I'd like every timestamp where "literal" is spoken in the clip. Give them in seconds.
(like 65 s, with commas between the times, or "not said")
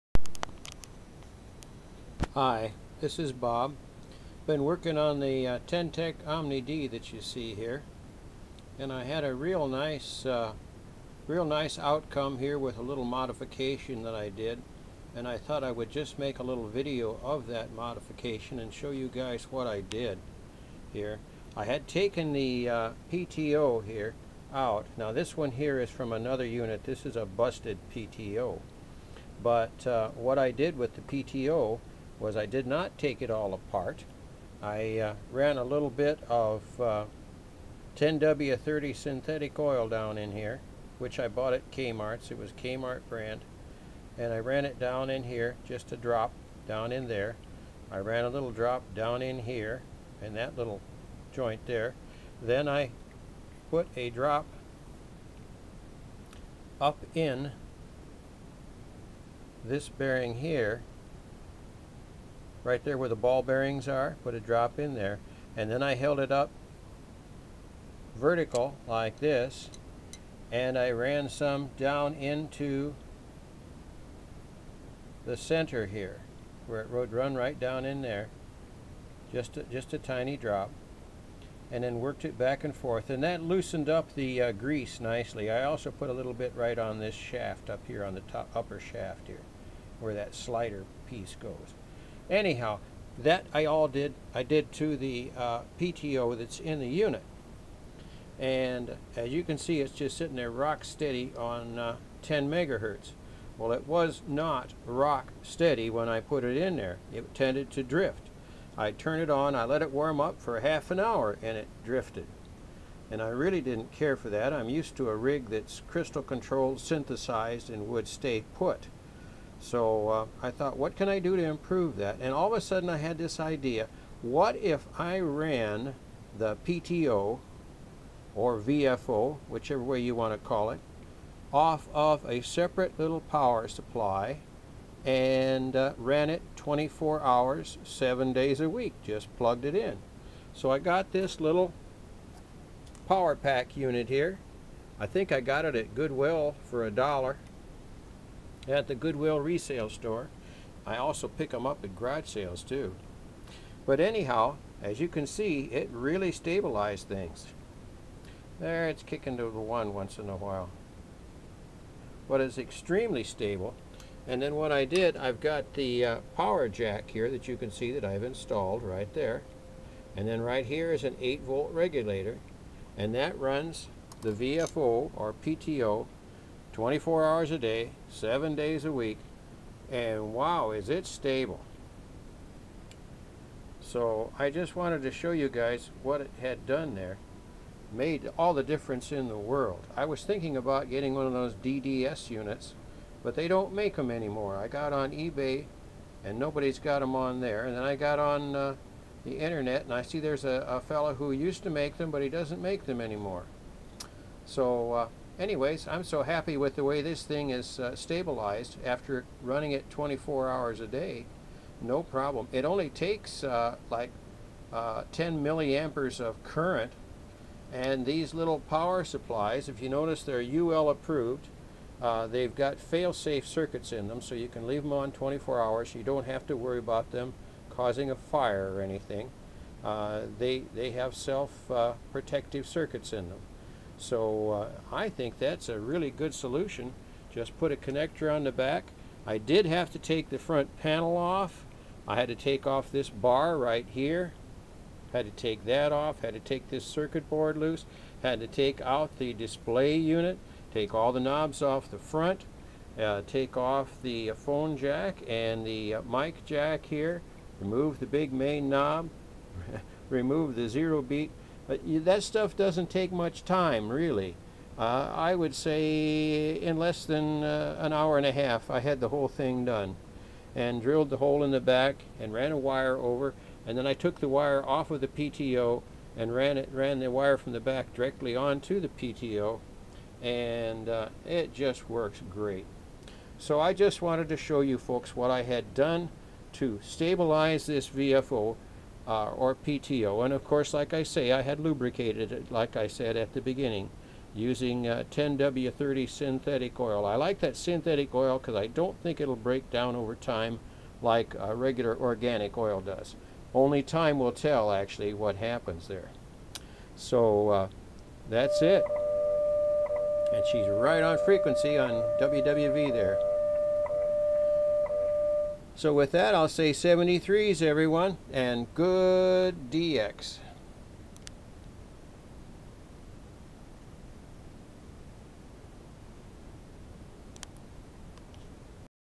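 not said.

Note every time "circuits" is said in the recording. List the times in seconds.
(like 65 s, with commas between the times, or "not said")
223 s, 232 s, 246 s.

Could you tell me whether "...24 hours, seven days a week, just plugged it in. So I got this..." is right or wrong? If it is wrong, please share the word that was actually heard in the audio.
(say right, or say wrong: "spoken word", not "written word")
right.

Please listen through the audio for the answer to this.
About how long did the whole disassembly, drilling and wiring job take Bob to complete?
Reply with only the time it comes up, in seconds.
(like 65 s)
267 s.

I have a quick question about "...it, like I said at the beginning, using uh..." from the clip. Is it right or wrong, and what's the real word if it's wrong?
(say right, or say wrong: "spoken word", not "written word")
right.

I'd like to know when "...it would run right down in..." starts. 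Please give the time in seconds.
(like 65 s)
76 s.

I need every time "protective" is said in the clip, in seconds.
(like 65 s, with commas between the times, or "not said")
231 s.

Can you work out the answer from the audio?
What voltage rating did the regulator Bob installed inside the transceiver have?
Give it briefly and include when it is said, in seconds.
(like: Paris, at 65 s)
8 volt, at 171 s.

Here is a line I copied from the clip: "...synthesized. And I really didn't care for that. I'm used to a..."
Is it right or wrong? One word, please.
wrong.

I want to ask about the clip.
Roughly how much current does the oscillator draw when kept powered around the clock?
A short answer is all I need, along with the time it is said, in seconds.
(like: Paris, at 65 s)
10 milliamperes, at 215 s.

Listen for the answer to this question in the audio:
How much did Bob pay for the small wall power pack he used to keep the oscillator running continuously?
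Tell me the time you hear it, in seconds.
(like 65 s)
146 s.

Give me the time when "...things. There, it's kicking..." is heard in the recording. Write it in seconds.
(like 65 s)
157 s.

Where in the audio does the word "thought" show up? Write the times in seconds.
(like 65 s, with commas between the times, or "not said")
15 s, 120 s.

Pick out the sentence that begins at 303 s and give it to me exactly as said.
Only time will tell, actually, what happens there.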